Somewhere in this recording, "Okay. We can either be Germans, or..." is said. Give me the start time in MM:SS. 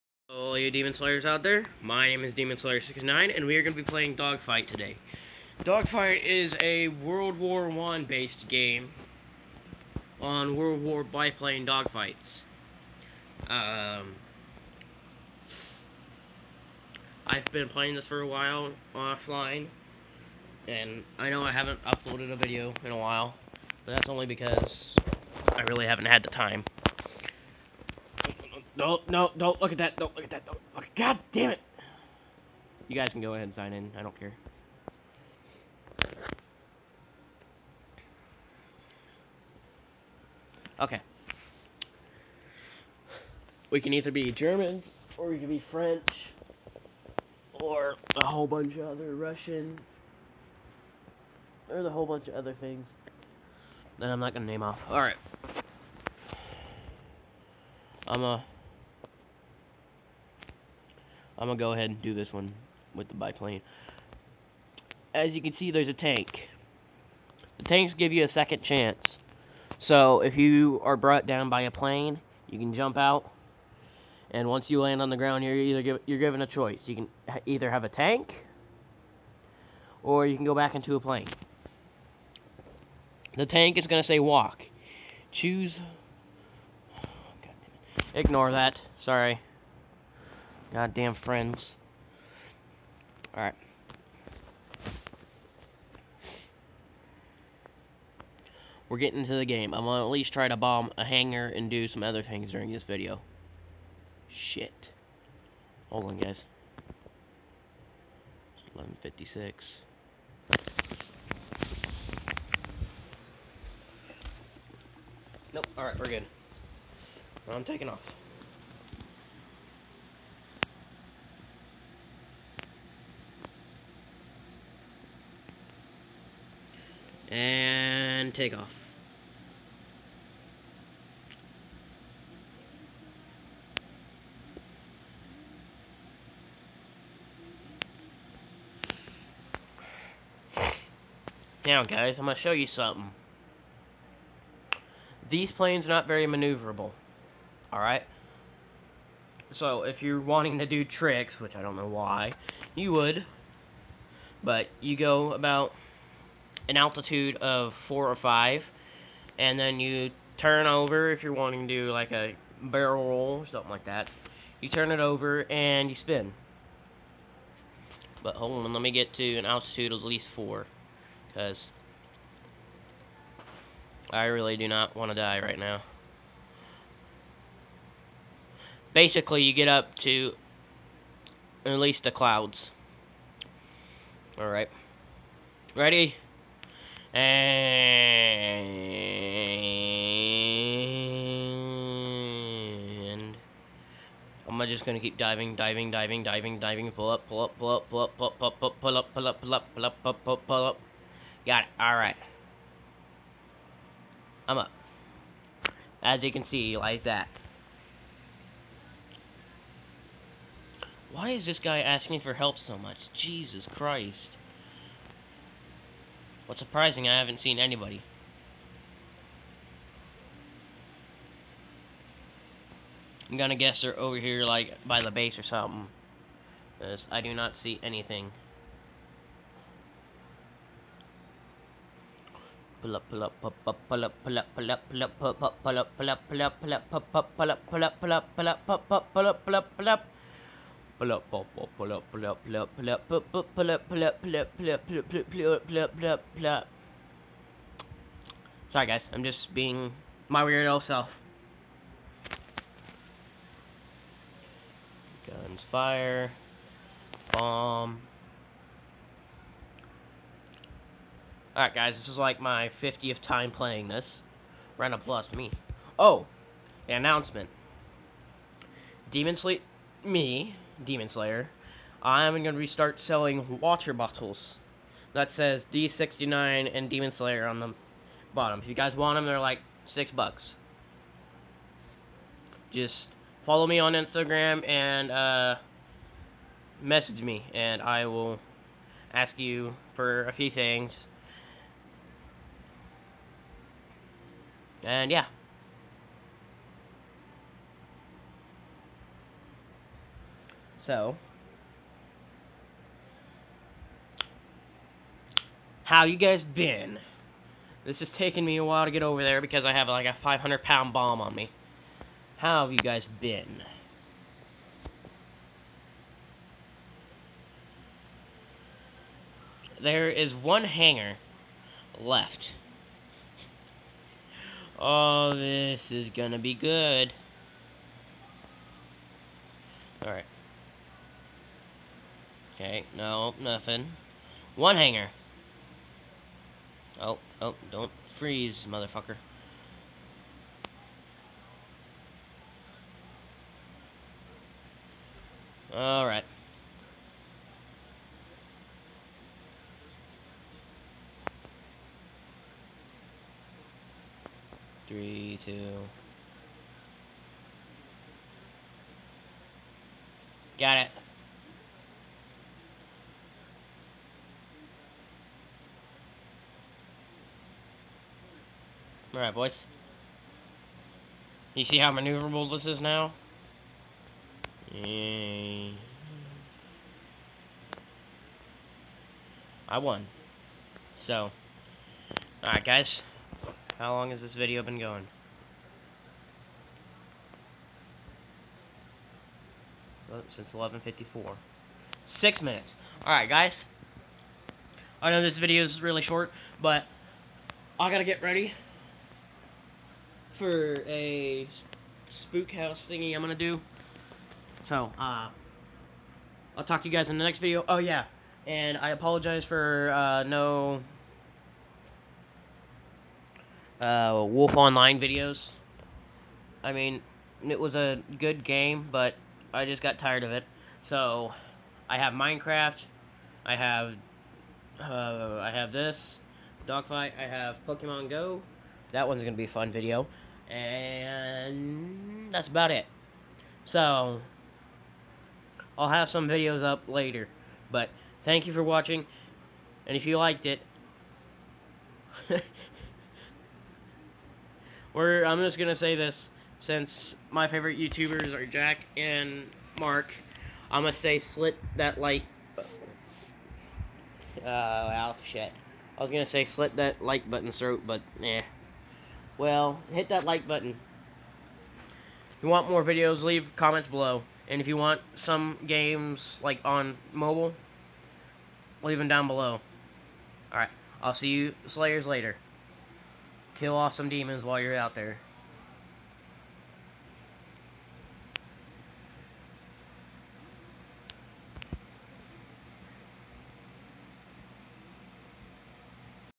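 00:40.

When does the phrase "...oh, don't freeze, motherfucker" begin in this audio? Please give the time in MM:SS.
05:37.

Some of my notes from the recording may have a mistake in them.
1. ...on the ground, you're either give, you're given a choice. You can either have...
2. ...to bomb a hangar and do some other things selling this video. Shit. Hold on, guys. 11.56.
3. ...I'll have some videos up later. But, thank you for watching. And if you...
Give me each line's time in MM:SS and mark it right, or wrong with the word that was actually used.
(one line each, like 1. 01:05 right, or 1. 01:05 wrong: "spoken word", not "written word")
1. 01:15 right
2. 01:40 wrong: "during", not "selling"
3. 07:15 right.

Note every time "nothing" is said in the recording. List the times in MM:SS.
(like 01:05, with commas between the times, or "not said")
05:33.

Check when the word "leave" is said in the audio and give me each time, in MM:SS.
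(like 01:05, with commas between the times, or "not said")
07:43, 07:48.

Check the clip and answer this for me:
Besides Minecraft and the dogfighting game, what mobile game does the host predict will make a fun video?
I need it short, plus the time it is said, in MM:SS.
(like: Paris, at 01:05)
Pokemon Go, at 07:07.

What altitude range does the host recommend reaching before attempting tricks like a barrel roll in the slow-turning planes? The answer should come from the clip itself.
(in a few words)
4 or 5.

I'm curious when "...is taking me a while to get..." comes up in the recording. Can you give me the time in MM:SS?
05:08.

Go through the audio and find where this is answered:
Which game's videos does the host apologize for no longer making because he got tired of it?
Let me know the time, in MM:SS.
06:54.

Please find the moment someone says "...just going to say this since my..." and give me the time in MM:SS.
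07:25.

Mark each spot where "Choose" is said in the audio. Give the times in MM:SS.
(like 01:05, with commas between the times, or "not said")
01:25.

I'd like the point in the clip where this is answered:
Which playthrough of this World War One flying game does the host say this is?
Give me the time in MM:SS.
04:22.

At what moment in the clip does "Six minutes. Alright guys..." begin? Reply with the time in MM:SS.
06:32.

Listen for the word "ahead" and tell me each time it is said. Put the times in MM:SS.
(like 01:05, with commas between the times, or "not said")
00:33, 01:01.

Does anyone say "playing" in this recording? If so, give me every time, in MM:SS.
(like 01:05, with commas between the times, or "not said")
00:03, 00:11, 00:17, 04:23.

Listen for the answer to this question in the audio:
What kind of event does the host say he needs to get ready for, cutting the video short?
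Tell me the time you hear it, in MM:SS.
06:42.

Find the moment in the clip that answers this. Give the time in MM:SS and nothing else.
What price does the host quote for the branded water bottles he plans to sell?
04:39.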